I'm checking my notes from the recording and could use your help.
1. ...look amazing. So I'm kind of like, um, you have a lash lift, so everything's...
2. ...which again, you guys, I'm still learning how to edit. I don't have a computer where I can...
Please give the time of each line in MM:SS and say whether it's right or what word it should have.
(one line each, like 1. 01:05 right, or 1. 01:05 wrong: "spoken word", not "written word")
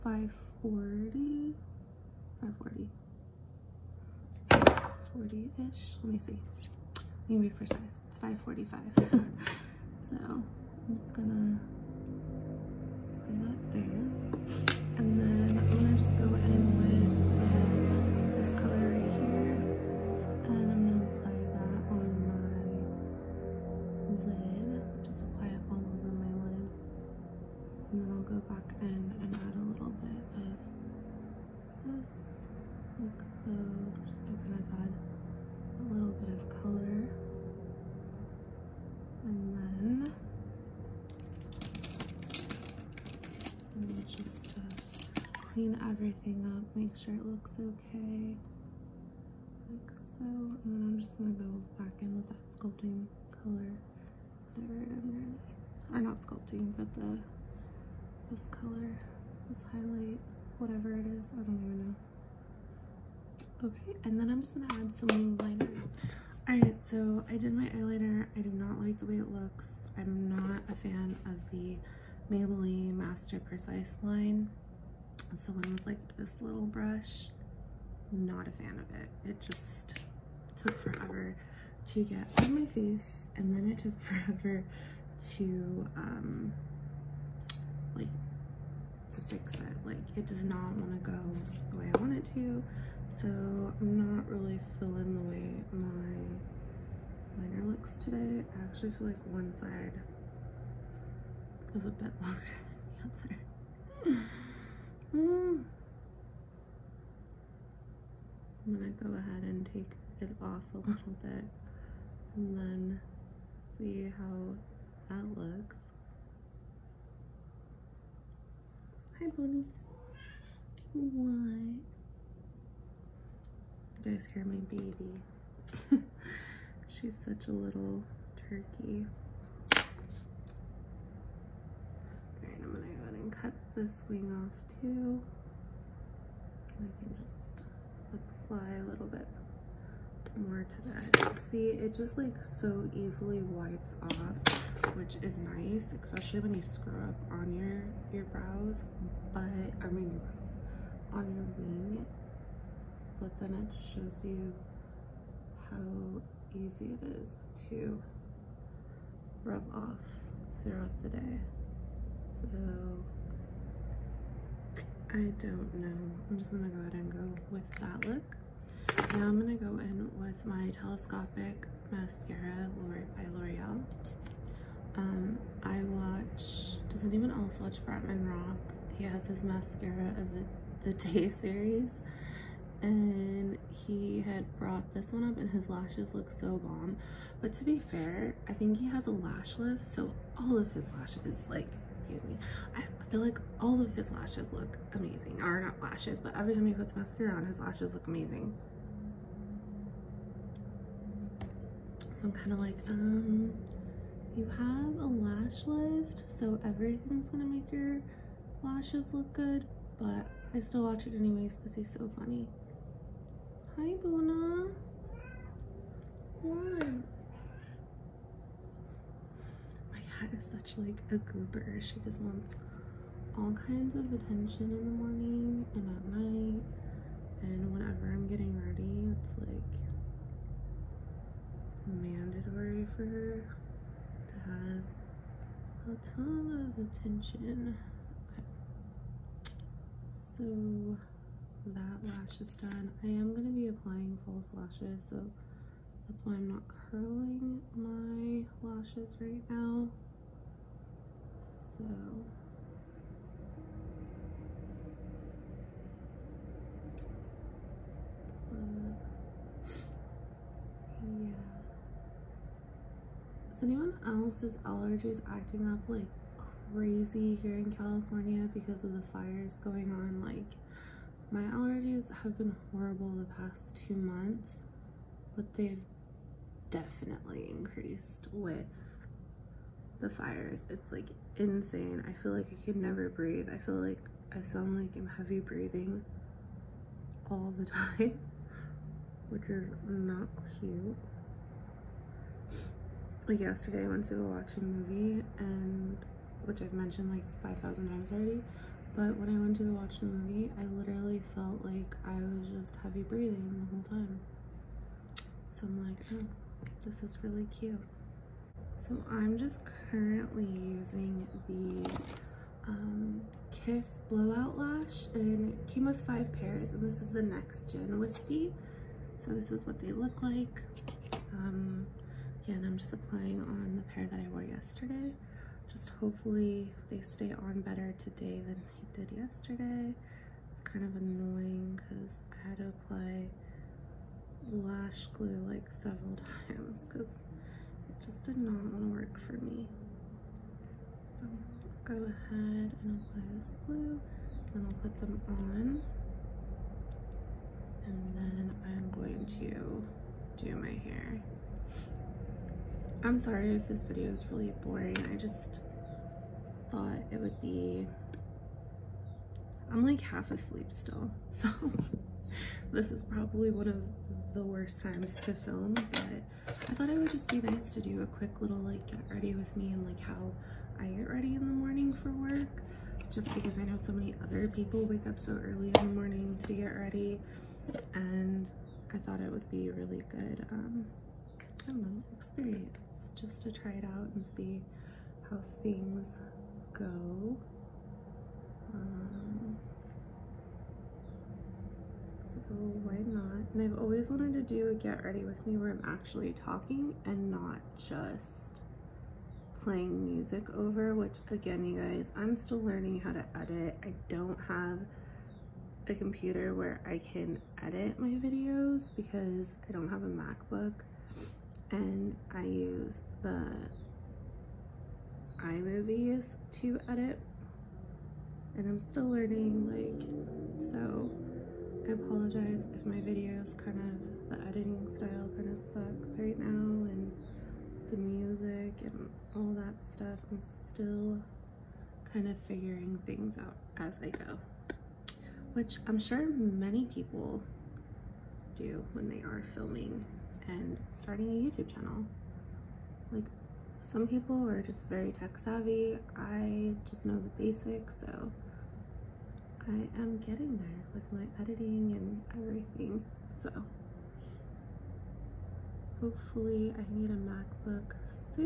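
1. 03:17 right
2. 06:40 right.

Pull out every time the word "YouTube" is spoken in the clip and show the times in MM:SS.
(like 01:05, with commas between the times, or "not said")
07:21.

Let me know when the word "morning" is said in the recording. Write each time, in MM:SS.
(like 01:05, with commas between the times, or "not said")
03:44, 06:11, 06:15.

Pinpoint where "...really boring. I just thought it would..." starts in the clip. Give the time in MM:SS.
05:54.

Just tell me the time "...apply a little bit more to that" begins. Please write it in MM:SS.
02:18.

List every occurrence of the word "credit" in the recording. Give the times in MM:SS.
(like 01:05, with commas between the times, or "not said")
not said.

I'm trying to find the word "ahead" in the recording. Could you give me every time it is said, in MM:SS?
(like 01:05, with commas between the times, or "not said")
01:49, 02:13, 02:46, 05:42.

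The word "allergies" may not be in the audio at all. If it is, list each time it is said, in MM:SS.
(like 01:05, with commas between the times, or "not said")
04:24, 04:31.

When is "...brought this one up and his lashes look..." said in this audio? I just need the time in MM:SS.
03:04.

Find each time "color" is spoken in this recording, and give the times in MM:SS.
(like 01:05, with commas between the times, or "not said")
00:53, 00:58.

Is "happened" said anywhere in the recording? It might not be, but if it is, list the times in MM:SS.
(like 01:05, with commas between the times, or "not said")
not said.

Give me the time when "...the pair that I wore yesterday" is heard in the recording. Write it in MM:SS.
05:23.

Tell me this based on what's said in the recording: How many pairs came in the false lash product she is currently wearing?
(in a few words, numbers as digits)
5.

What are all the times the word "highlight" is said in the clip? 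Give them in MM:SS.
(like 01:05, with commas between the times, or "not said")
00:59.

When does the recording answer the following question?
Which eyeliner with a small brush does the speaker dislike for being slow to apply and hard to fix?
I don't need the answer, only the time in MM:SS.
01:12.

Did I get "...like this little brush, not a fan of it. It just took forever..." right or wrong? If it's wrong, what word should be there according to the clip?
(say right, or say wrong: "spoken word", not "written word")
right.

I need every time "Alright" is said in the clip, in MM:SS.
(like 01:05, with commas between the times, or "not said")
01:06, 02:12.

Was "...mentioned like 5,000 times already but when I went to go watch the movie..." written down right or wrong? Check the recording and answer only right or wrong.
right.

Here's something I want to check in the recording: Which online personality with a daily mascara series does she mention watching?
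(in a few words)
Bretman Rock.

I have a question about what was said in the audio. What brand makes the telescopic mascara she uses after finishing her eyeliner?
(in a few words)
L'Oreal.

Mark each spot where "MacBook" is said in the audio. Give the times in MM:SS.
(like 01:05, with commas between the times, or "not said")
06:50, 07:37.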